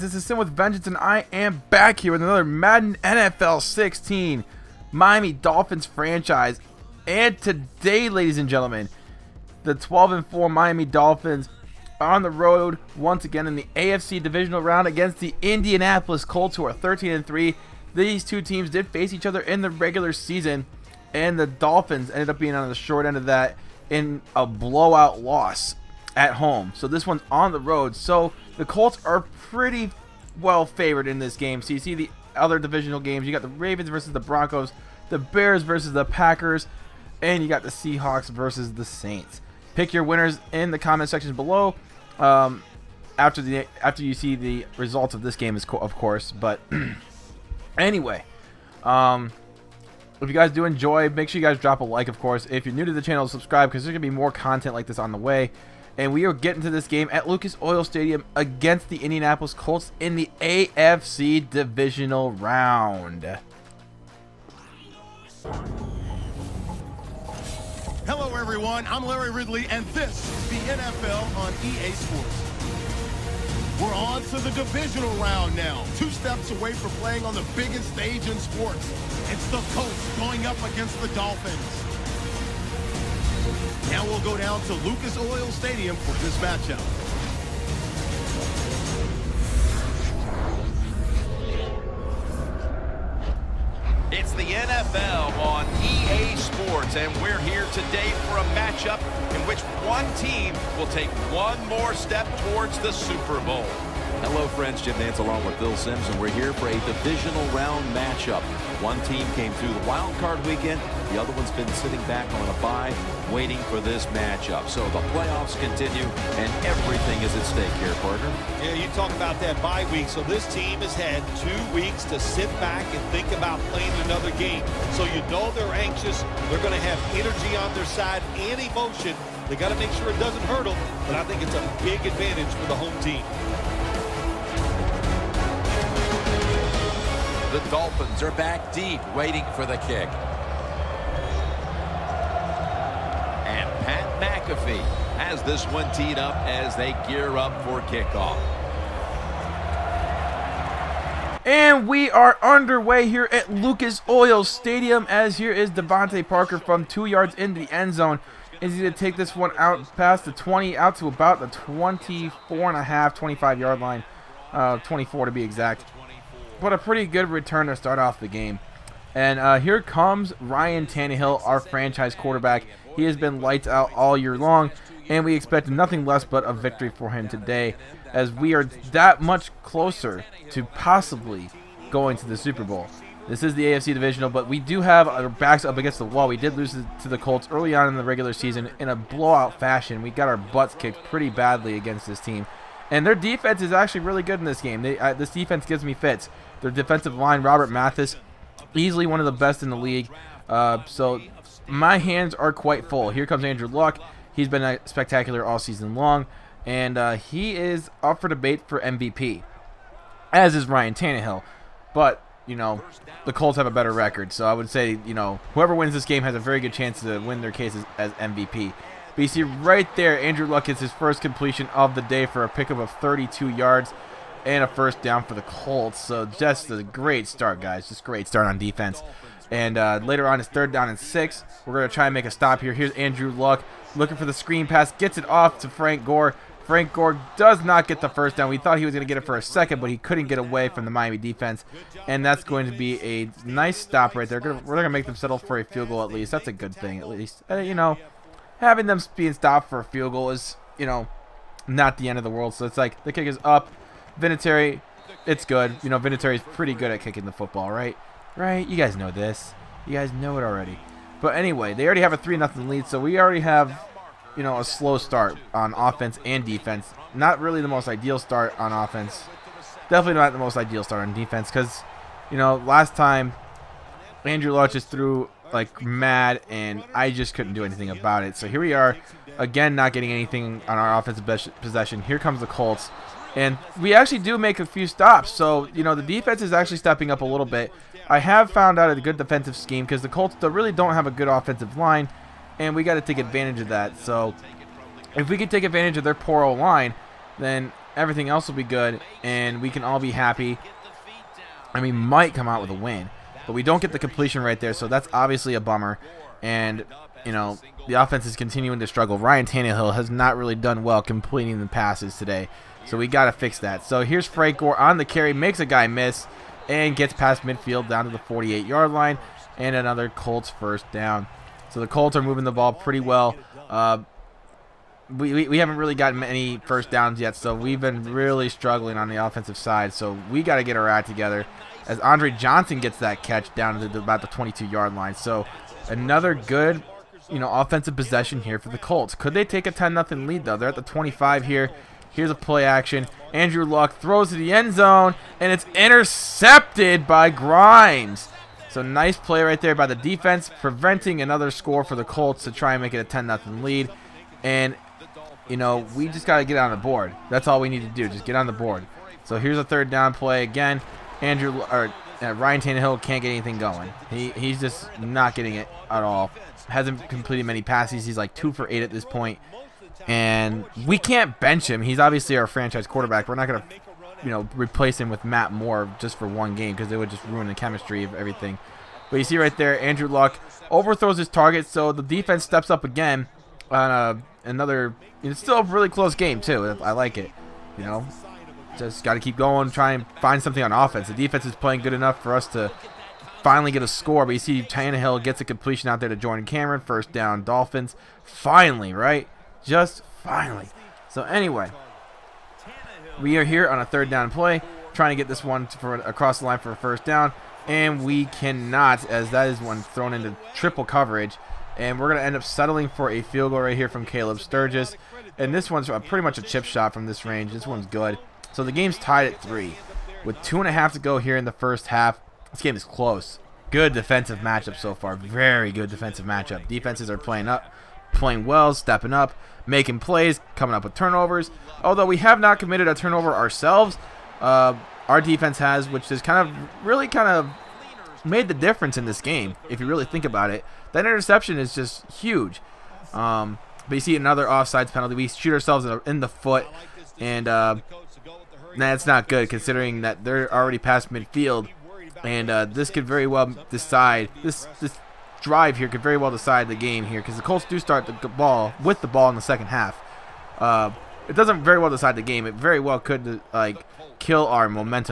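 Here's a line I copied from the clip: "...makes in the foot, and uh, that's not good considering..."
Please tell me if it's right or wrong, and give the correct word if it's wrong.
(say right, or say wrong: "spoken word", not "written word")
wrong: "ourselves", not "makes".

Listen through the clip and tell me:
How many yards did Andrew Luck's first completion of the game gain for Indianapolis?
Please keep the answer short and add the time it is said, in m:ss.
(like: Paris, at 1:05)
32, at 3:42.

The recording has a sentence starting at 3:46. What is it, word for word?
So just a great start, guys.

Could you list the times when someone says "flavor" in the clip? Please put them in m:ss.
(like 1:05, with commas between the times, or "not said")
not said.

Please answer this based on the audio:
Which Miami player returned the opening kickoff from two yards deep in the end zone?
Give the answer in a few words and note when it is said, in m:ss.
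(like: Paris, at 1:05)
DeVante Parker, at 2:35.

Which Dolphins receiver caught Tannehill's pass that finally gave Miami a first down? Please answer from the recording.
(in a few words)
Jordan Cameron.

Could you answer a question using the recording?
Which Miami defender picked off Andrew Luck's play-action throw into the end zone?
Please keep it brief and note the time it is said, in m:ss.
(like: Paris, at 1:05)
Grimes, at 5:47.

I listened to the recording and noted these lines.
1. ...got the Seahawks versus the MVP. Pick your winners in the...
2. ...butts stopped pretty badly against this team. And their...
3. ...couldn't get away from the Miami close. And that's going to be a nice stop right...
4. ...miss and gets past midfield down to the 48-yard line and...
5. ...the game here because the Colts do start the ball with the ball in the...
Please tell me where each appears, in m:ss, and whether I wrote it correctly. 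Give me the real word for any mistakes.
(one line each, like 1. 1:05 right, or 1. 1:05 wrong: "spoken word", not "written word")
1. 0:37 wrong: "Saints", not "MVP"
2. 3:10 wrong: "kicked", not "stopped"
3. 3:59 wrong: "defense", not "close"
4. 5:15 right
5. 7:36 right.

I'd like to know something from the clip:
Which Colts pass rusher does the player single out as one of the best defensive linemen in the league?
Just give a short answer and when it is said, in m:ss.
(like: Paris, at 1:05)
Robert Mathis, at 3:17.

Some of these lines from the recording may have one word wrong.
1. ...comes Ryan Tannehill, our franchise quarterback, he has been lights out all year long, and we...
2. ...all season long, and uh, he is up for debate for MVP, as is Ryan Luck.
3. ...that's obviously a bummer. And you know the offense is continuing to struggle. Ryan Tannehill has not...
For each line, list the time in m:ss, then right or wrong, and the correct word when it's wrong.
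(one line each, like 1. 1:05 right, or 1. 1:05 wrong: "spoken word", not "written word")
1. 2:49 right
2. 3:25 wrong: "Tannehill", not "Luck"
3. 5:04 right.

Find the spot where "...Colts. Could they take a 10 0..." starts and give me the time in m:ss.
5:38.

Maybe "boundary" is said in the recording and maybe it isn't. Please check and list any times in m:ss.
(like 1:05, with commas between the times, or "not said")
not said.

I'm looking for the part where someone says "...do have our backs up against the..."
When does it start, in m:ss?
3:04.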